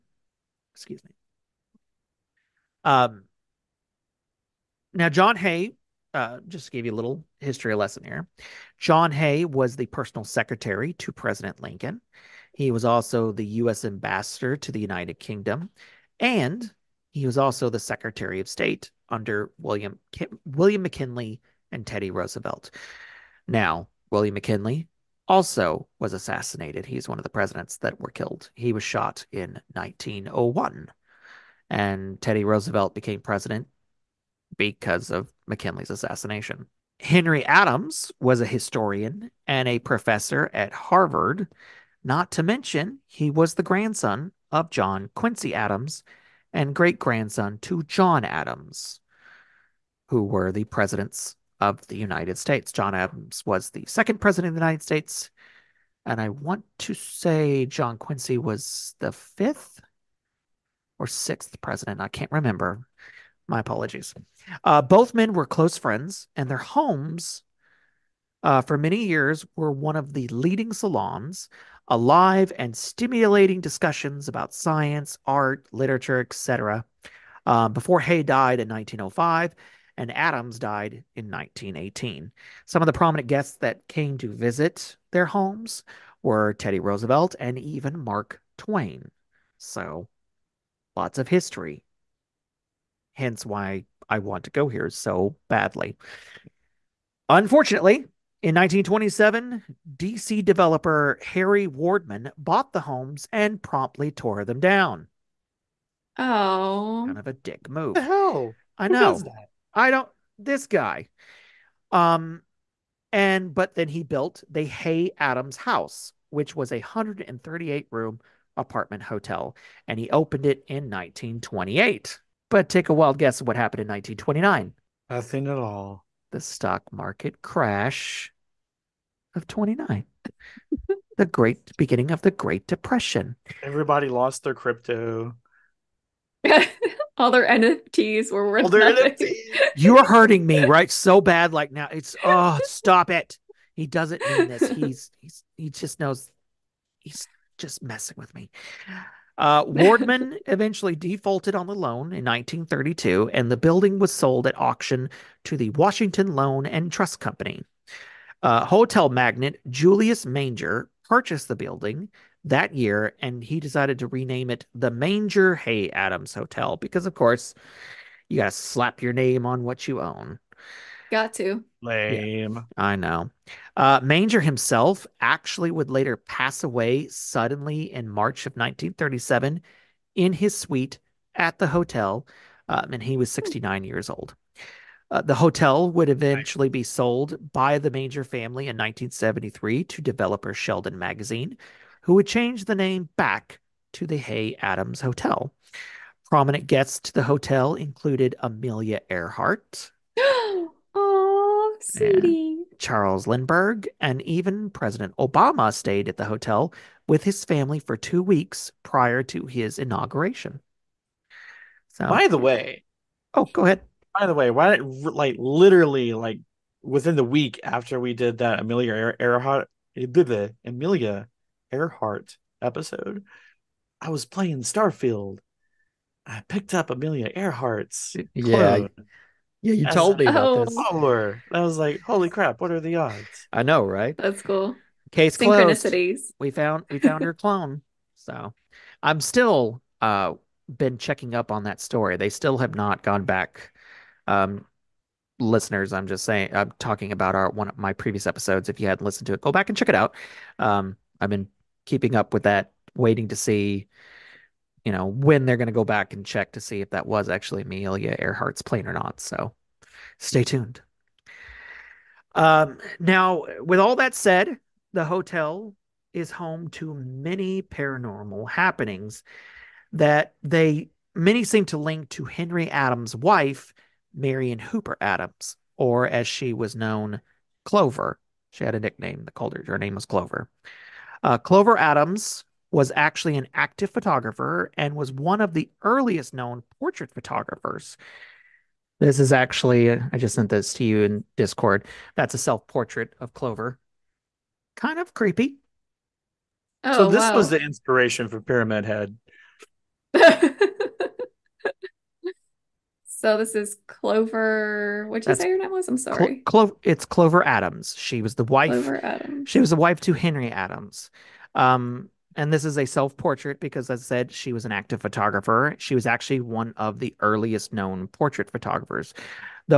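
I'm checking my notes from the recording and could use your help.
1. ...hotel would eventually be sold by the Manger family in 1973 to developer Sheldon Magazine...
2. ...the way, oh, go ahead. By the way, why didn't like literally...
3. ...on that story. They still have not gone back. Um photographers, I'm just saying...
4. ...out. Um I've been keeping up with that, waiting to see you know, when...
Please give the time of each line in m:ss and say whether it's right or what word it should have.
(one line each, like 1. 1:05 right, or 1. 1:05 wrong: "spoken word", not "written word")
1. 3:05 right
2. 3:32 right
3. 4:01 wrong: "listeners", not "photographers"
4. 4:09 right.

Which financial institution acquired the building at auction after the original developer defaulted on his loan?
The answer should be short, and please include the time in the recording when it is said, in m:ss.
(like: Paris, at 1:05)
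Washington Loan and Trust Company, at 2:35.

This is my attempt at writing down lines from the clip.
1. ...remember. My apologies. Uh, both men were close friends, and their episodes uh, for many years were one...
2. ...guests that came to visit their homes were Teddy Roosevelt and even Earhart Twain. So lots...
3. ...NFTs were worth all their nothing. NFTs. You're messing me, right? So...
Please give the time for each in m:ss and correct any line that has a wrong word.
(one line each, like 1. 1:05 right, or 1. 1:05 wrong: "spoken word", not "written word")
1. 1:02 wrong: "homes", not "episodes"
2. 1:23 wrong: "Mark", not "Earhart"
3. 2:17 wrong: "hurting", not "messing".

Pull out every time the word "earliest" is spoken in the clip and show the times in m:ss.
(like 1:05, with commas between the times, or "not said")
4:45, 5:17.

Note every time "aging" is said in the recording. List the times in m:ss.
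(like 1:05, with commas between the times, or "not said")
not said.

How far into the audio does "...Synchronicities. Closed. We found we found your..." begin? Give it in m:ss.
3:55.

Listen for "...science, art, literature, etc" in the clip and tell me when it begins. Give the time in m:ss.
1:14.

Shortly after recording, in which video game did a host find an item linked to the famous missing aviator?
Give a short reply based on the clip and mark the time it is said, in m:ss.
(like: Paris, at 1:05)
Starfield, at 3:44.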